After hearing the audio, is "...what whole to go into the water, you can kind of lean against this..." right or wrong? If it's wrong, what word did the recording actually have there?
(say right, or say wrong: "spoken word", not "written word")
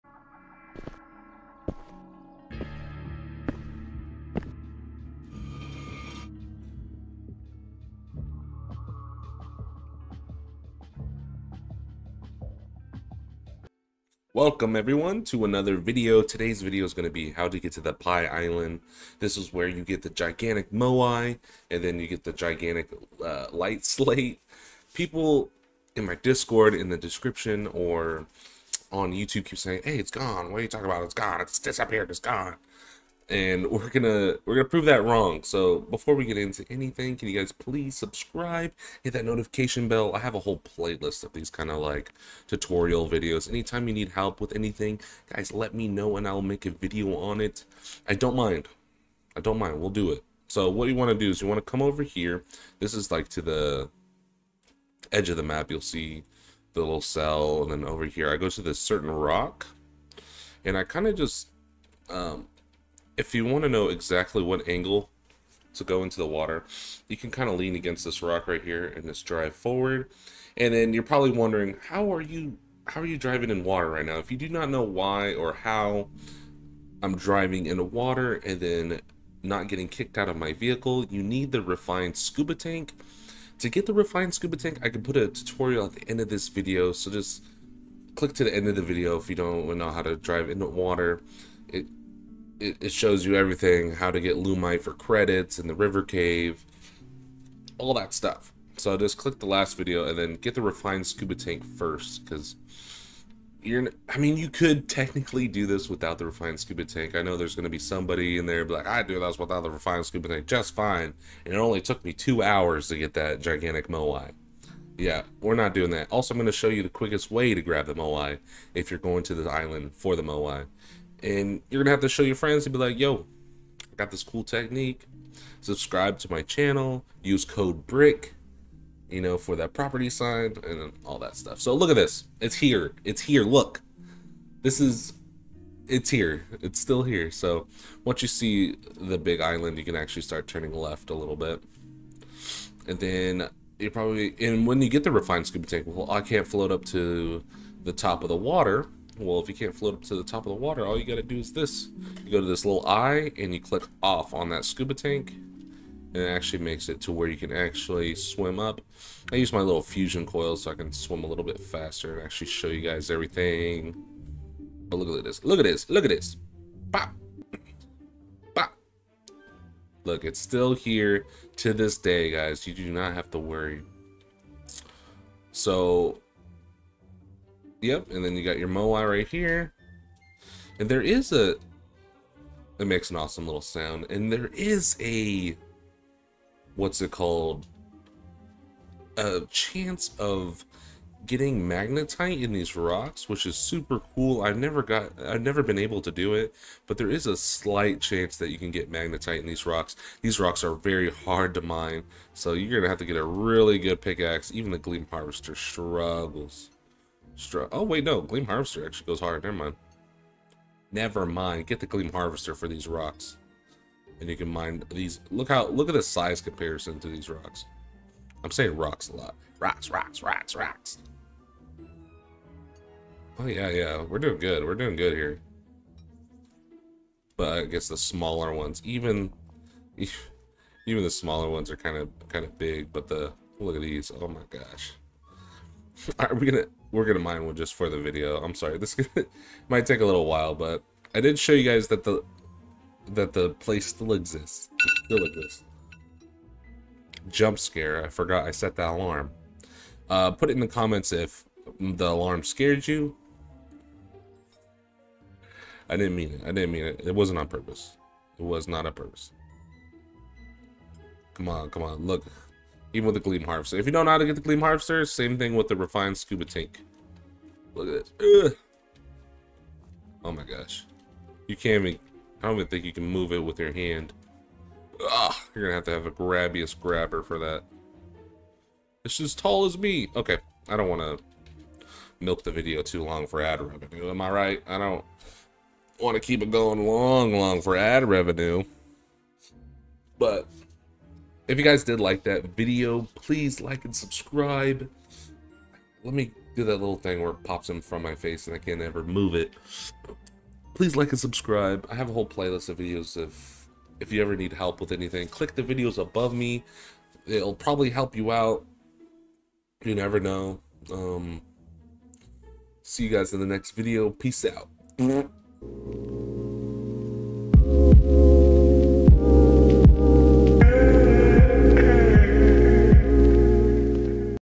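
wrong: "angle", not "whole".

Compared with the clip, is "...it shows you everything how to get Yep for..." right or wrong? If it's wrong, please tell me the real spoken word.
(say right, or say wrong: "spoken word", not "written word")
wrong: "Lumite", not "Yep".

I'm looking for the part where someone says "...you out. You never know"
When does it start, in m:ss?
5:08.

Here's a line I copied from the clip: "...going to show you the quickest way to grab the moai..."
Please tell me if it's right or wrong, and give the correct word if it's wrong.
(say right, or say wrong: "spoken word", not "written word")
right.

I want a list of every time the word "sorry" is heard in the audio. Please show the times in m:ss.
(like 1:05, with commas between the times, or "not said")
3:58.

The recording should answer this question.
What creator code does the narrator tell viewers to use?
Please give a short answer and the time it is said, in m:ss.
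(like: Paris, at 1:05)
BRICK, at 2:07.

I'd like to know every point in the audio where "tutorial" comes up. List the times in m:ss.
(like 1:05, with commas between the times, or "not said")
0:42, 1:25.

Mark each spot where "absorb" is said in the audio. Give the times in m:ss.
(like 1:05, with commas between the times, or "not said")
not said.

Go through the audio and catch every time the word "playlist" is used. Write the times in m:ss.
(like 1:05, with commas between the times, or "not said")
0:40, 5:02.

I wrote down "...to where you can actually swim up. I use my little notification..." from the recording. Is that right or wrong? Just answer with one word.
wrong.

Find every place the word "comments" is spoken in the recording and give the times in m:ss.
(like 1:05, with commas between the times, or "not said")
4:10.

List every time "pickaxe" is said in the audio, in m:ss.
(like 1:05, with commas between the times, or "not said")
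3:24.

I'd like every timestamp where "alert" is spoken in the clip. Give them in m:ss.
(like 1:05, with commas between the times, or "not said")
not said.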